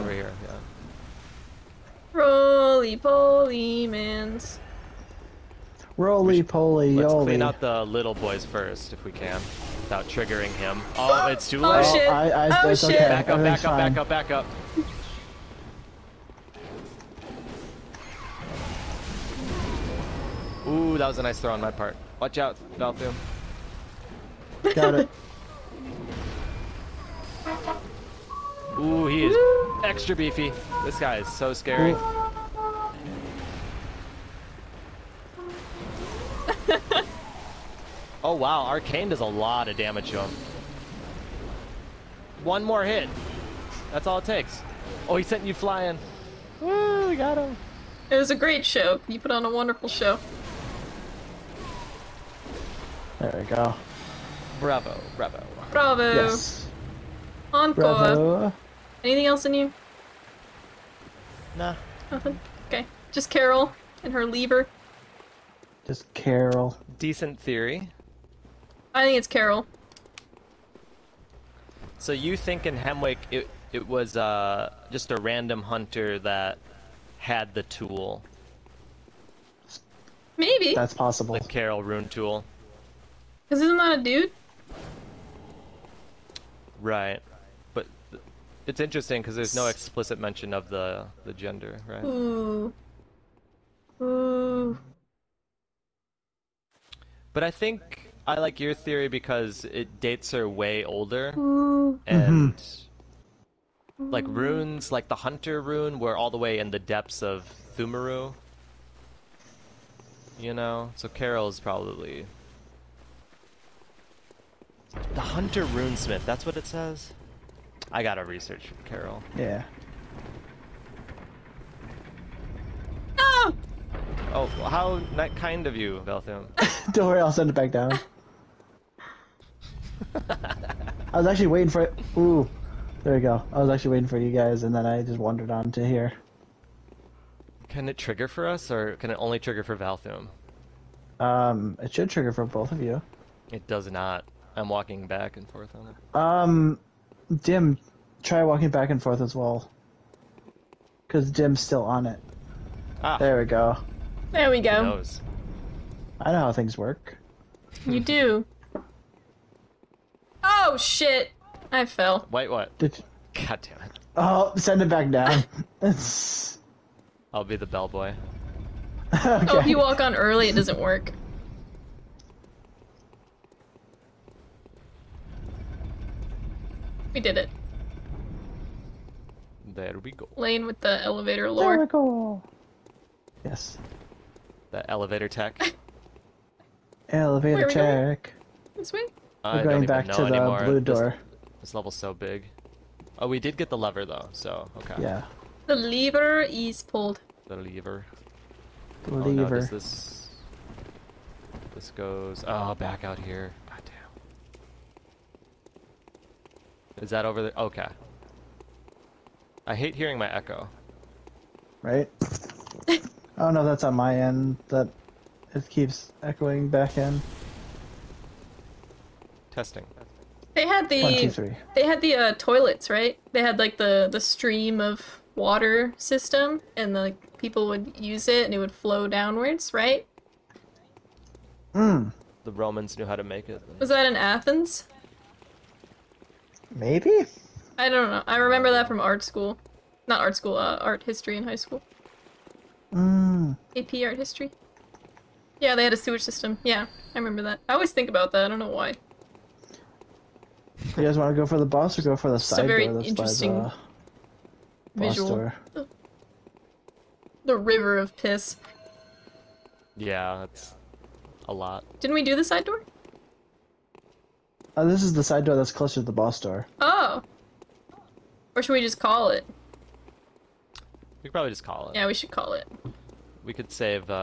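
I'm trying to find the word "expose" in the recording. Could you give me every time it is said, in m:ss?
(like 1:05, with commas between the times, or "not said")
not said.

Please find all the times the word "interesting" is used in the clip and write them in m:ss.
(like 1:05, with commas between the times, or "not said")
1:28, 4:12.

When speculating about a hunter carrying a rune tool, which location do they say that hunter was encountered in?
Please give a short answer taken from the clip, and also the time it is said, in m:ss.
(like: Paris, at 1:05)
Hemwick, at 1:12.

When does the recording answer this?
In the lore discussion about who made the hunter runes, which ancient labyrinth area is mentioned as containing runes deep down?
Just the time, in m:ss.
1:47.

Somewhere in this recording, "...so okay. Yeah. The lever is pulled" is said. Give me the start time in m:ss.
3:14.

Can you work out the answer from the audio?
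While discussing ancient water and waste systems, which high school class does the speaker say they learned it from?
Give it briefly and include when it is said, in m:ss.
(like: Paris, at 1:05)
AP art history, at 4:03.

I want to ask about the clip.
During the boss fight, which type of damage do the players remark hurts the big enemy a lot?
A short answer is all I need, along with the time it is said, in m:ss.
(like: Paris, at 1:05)
Arcane, at 0:38.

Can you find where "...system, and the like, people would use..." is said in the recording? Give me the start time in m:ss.
3:45.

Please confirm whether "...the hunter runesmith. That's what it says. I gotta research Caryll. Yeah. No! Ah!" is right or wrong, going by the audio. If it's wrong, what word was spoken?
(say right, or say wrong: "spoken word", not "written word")
right.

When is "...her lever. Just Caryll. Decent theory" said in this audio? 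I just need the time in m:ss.
1:04.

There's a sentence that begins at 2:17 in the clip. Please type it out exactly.
Can it trigger for us, or can it only trigger for Valthum?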